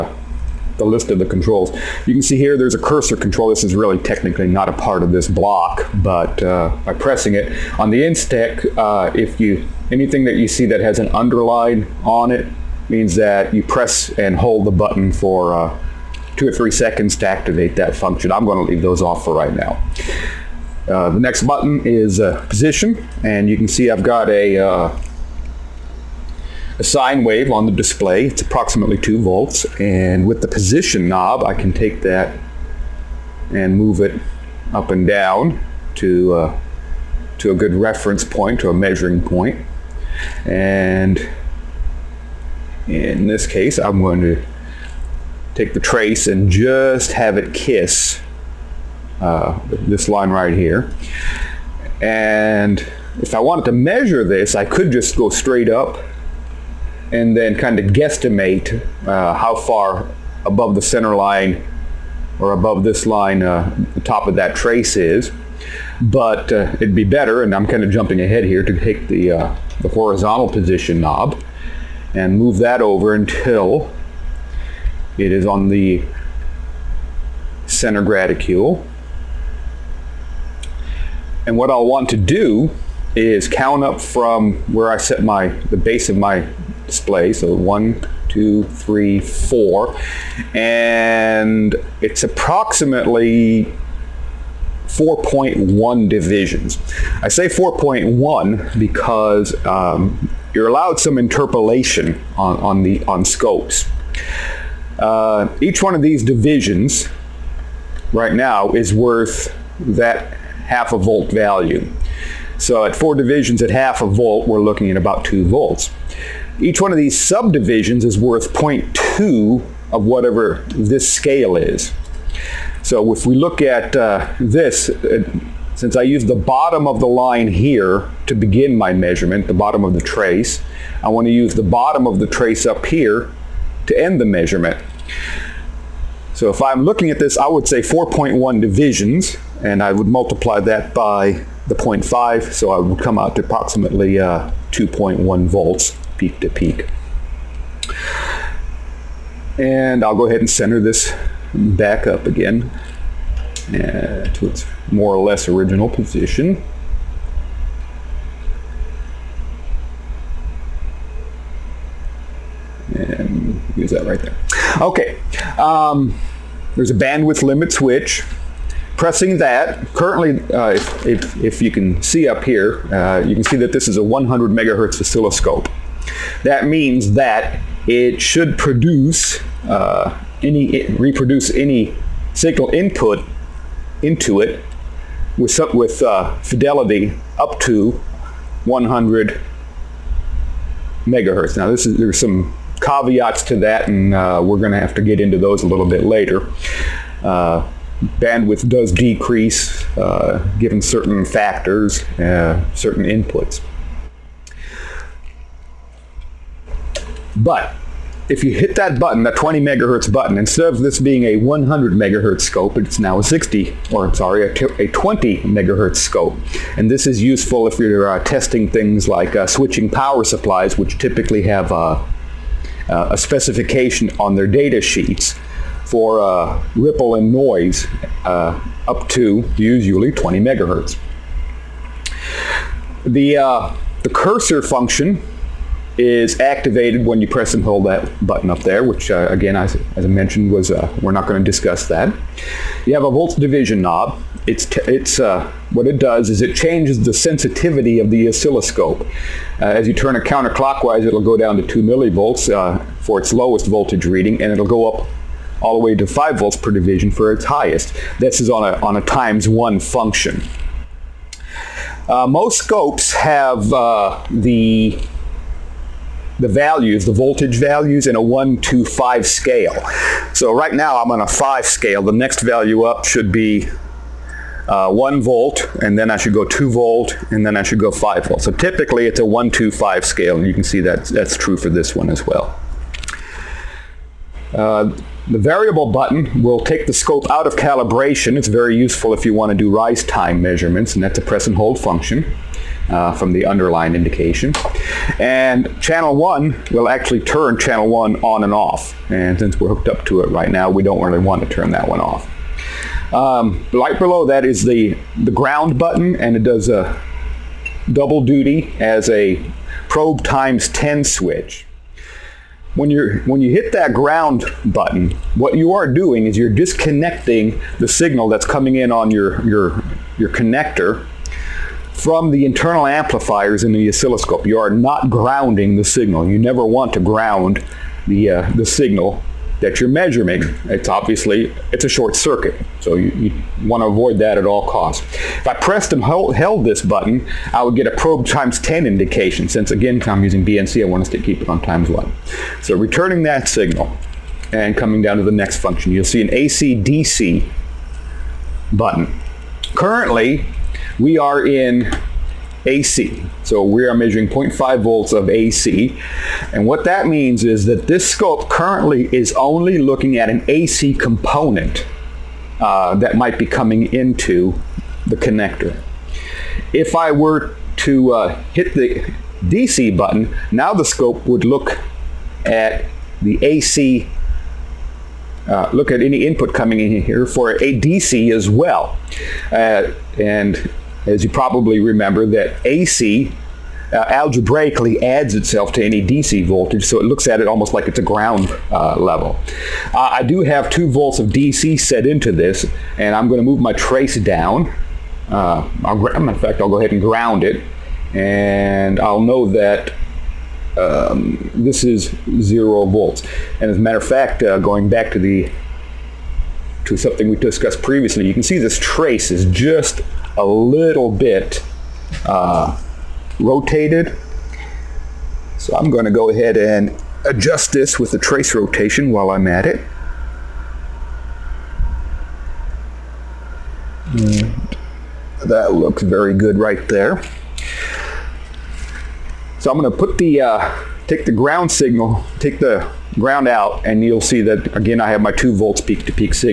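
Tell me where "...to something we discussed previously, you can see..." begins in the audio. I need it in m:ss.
6:46.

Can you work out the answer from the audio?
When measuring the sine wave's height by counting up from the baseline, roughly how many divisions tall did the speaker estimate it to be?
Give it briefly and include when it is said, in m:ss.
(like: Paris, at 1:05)
4.1 divisions, at 1:32.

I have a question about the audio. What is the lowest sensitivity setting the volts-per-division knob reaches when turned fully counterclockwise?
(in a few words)
2 millivolts.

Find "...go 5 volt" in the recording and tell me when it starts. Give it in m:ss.
4:37.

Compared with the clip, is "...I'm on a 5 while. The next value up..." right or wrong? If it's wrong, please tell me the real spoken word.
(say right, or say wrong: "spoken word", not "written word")
wrong: "scale", not "while".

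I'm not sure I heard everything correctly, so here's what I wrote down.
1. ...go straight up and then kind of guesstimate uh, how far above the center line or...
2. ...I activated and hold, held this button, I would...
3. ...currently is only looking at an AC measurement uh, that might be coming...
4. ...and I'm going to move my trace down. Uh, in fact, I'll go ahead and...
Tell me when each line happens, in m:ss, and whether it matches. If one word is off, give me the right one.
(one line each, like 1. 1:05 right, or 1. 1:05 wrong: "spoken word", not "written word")
1. 0:55 right
2. 5:35 wrong: "pressed", not "activated"
3. 5:58 wrong: "component", not "measurement"
4. 6:32 right.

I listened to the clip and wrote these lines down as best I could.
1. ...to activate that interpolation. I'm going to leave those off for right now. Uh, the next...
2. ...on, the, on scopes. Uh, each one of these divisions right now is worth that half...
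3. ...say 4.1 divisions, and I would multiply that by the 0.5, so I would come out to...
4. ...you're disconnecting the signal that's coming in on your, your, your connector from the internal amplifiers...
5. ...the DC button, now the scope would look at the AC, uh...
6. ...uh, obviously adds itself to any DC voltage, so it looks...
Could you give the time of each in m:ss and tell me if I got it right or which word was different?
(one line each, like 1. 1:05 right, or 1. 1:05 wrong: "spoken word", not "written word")
1. 0:17 wrong: "function", not "interpolation"
2. 1:42 right
3. 2:17 right
4. 5:16 right
5. 6:08 right
6. 6:23 wrong: "algebraically", not "obviously".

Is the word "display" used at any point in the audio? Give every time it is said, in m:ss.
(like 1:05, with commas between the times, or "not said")
0:27, 1:26.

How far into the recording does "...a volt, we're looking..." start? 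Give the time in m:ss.
1:54.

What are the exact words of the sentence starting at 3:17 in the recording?
Uh, bandwidth does decrease uh, given certain factors, uh, certain inputs.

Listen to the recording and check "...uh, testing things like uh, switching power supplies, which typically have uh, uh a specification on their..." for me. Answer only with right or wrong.
right.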